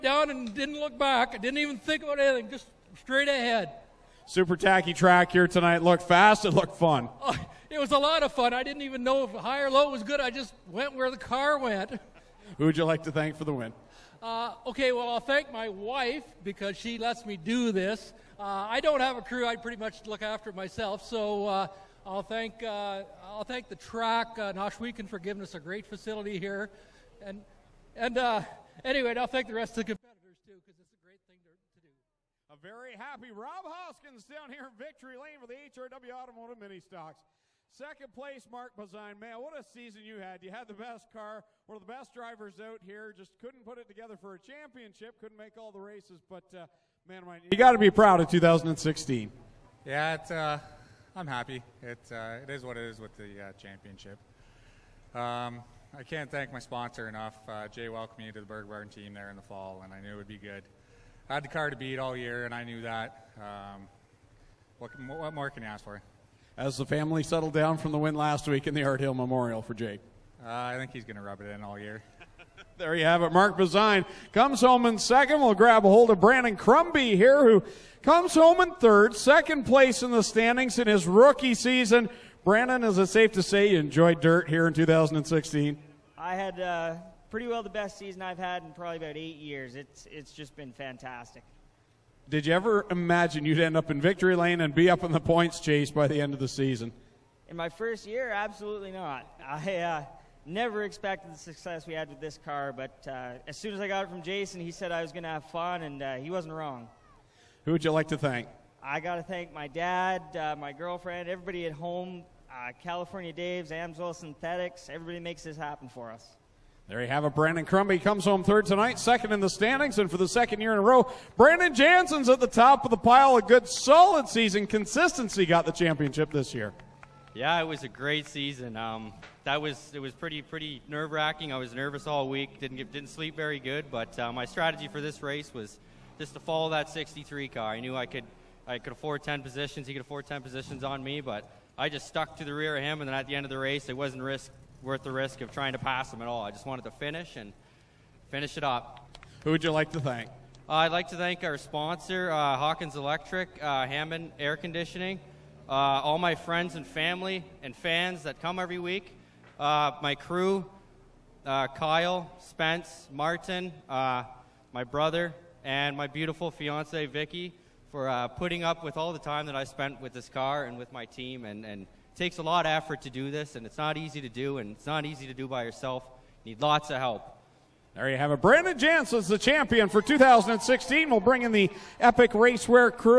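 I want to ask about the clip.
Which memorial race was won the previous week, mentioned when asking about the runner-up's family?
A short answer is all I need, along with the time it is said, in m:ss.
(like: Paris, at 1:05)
Art Hill Memorial, at 1:08.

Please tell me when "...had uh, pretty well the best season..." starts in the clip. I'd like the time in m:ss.
1:26.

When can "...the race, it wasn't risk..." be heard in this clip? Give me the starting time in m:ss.
2:23.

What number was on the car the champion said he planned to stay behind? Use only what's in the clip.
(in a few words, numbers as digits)
63.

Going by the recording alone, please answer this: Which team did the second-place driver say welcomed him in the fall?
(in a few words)
Berg.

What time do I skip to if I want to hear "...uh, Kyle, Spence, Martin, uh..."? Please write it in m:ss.
2:41.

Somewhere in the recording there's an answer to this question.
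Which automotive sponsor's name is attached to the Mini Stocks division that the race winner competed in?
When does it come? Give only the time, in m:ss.
0:35.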